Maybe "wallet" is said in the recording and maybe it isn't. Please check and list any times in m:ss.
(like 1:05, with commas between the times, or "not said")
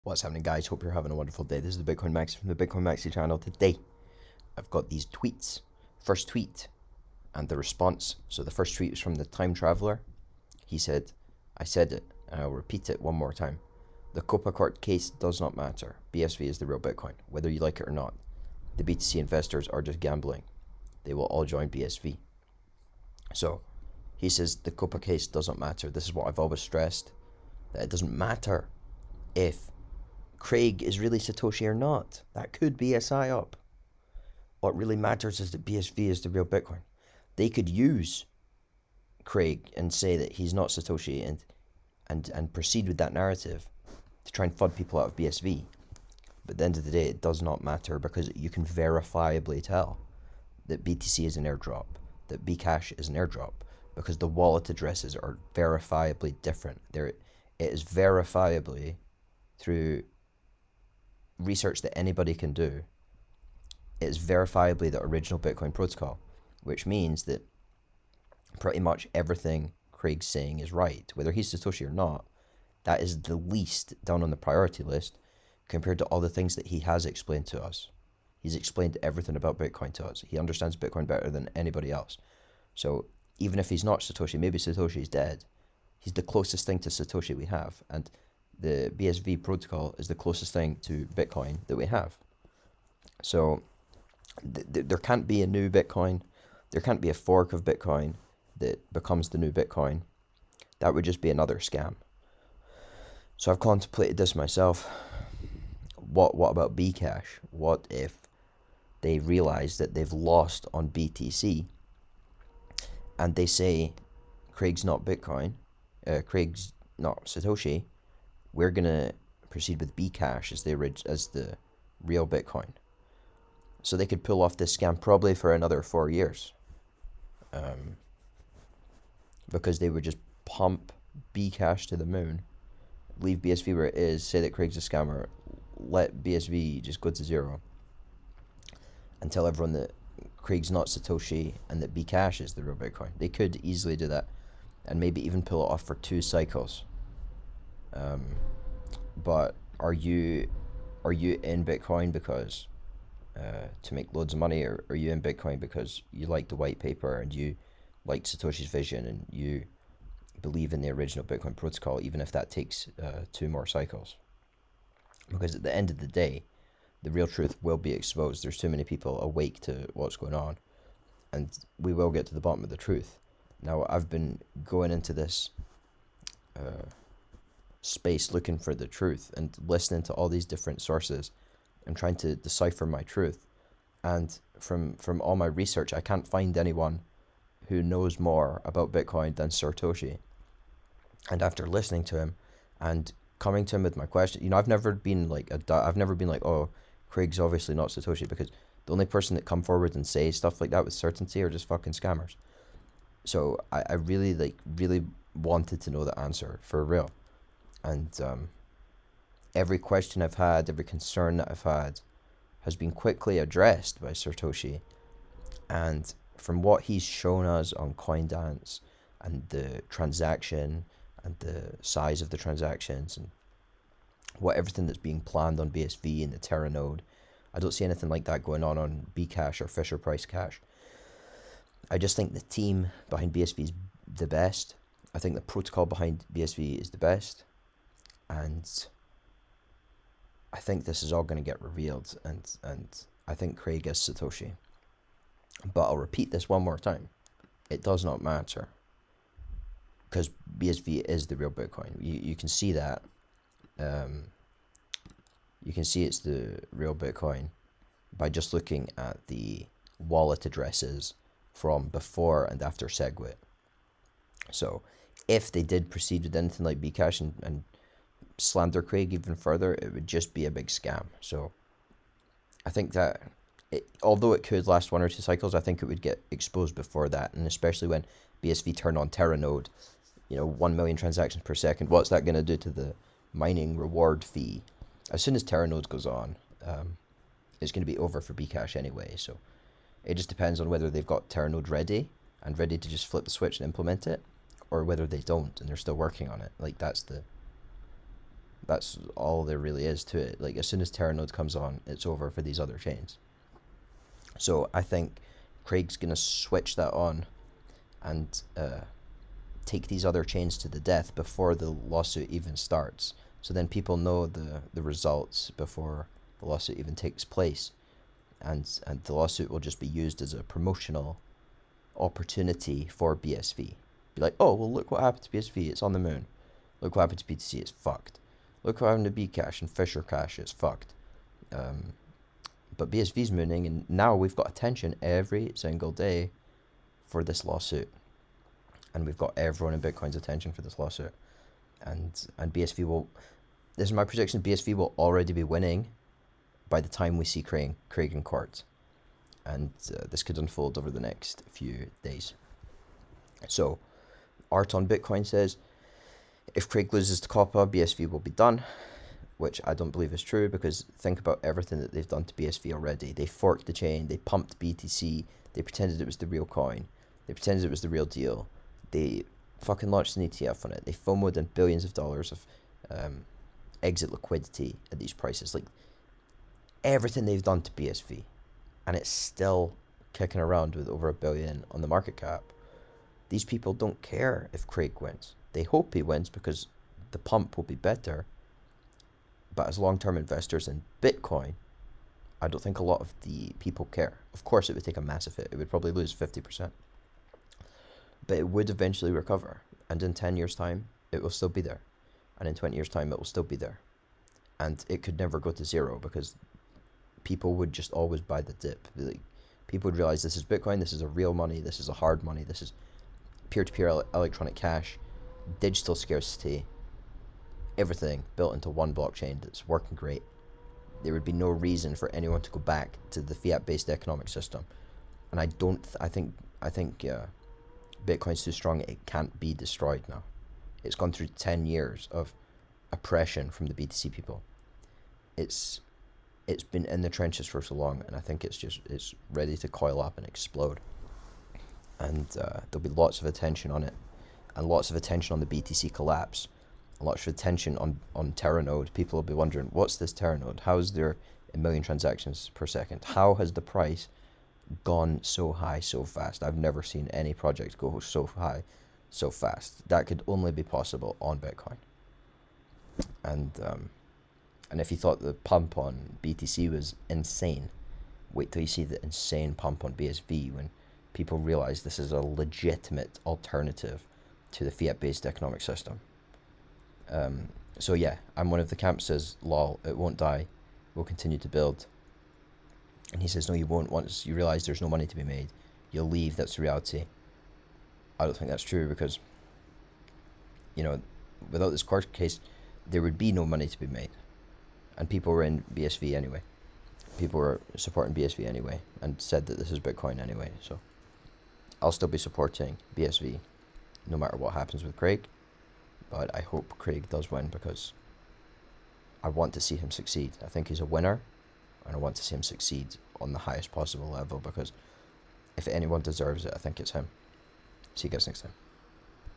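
0:54, 4:20.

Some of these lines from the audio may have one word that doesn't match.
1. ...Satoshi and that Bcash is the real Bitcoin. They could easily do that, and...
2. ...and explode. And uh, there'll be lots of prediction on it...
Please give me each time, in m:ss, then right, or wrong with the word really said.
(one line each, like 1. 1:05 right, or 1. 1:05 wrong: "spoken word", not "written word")
1. 2:20 right
2. 7:20 wrong: "attention", not "prediction".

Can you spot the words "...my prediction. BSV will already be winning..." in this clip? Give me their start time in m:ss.
5:43.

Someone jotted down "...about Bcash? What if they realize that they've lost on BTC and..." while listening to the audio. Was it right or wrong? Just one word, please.
right.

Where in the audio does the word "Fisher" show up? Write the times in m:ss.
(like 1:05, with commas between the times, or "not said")
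3:49, 5:29.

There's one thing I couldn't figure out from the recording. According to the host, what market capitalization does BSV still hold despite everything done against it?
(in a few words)
over a billion.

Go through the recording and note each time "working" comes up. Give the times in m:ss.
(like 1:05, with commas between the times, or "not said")
4:55, 6:59.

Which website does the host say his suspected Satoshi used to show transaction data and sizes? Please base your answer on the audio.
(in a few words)
CoinDance.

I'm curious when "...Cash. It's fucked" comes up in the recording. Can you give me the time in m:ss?
5:30.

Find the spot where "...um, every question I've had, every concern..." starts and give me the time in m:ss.
3:28.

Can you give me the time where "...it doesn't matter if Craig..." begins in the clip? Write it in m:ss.
0:27.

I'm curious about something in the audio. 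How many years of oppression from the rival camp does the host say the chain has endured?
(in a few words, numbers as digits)
10 years.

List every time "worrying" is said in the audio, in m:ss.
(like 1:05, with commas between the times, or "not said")
not said.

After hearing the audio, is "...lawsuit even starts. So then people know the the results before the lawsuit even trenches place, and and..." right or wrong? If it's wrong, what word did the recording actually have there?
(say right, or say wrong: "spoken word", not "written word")
wrong: "takes", not "trenches".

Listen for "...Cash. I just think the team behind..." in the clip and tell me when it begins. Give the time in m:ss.
3:50.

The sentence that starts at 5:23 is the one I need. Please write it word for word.
Be like, oh well, look what happened to BSV.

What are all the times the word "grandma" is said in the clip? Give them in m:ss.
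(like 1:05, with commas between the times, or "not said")
not said.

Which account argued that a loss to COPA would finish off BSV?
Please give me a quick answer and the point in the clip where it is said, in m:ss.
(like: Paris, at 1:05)
Art on Bitcoin, at 5:54.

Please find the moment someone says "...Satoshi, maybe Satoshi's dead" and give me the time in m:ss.
1:23.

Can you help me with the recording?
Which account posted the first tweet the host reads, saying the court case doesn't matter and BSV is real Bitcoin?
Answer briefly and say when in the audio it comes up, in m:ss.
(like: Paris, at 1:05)
The Time Traveler, at 0:09.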